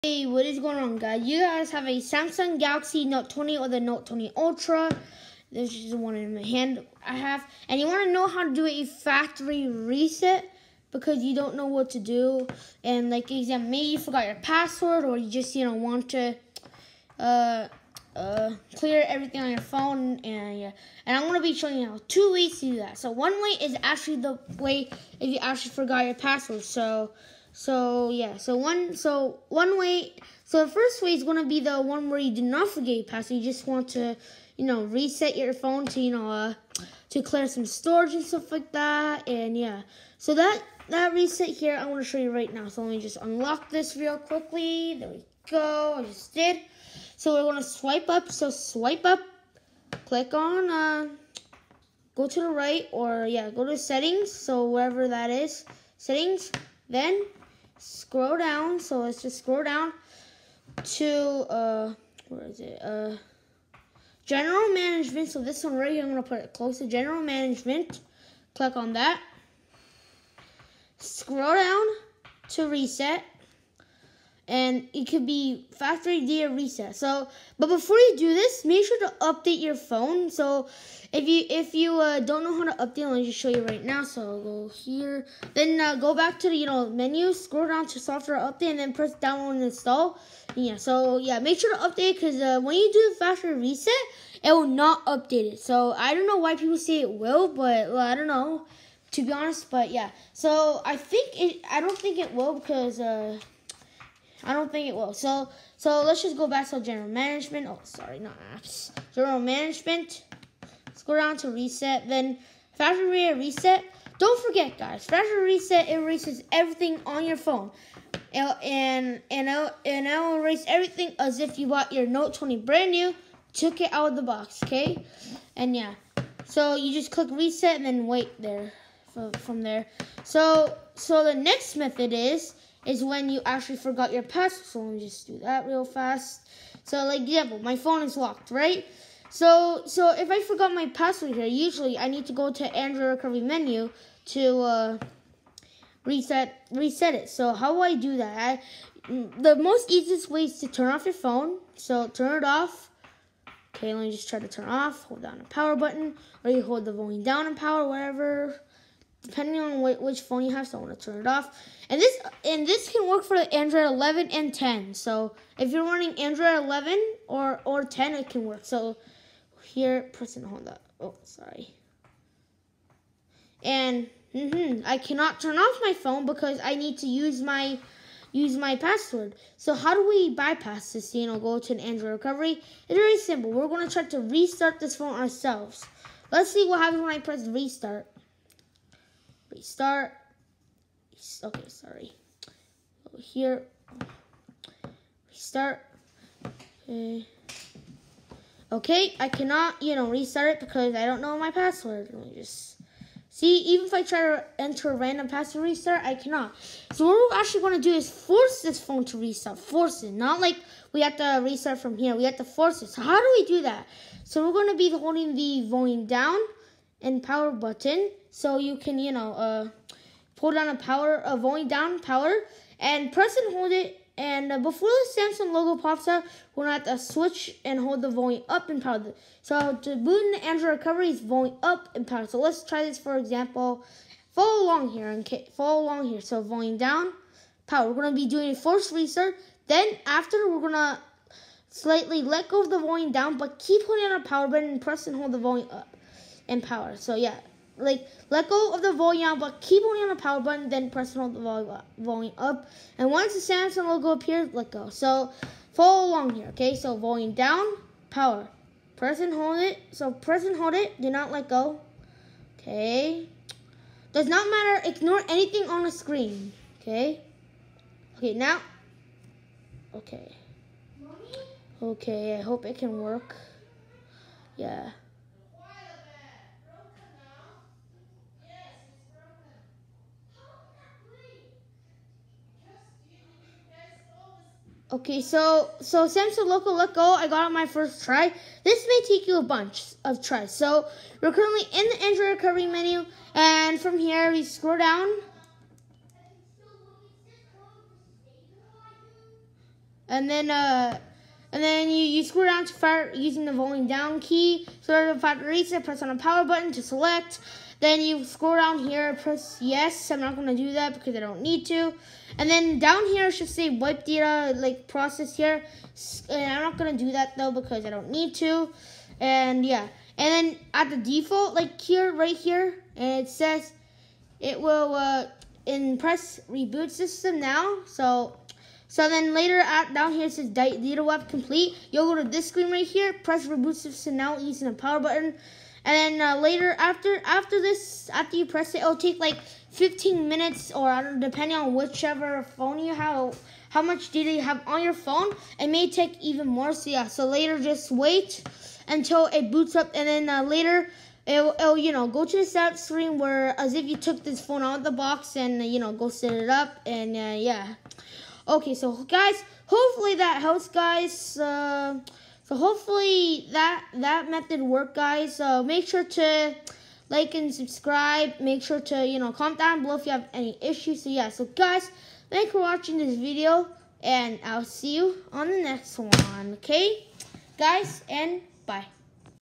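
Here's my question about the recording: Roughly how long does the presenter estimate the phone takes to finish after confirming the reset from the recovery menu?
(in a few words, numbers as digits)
15 minutes.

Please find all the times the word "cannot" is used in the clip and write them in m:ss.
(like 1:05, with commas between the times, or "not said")
2:55, 3:19, 3:26.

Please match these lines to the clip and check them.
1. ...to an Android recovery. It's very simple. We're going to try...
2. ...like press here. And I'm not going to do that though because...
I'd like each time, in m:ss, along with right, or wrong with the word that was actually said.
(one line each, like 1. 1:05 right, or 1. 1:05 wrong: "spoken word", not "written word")
1. 3:01 right
2. 5:14 wrong: "process", not "press".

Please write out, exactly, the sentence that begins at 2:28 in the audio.
I, the most easiest way is to turn off your phone.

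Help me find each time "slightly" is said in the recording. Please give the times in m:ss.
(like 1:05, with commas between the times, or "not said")
4:01.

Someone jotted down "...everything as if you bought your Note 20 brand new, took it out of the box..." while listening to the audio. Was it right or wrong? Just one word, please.
right.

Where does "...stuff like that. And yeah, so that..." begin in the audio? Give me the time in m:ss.
0:38.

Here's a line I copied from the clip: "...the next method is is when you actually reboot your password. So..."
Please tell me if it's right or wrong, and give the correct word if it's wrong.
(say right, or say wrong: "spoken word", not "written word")
wrong: "forgot", not "reboot".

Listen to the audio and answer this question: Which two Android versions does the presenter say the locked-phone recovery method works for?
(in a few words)
Android 11 and 10.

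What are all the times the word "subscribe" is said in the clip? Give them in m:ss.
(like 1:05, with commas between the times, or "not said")
6:07.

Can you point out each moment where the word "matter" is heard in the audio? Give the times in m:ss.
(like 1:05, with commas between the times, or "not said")
4:24.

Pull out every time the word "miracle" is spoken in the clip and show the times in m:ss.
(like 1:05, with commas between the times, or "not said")
not said.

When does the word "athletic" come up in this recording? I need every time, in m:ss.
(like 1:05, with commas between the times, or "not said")
not said.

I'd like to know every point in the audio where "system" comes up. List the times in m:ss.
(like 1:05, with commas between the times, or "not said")
5:26, 5:33.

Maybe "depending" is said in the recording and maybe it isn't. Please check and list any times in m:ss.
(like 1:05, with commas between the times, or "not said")
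2:39, 5:41.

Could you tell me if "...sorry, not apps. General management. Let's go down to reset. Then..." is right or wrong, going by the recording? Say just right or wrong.
right.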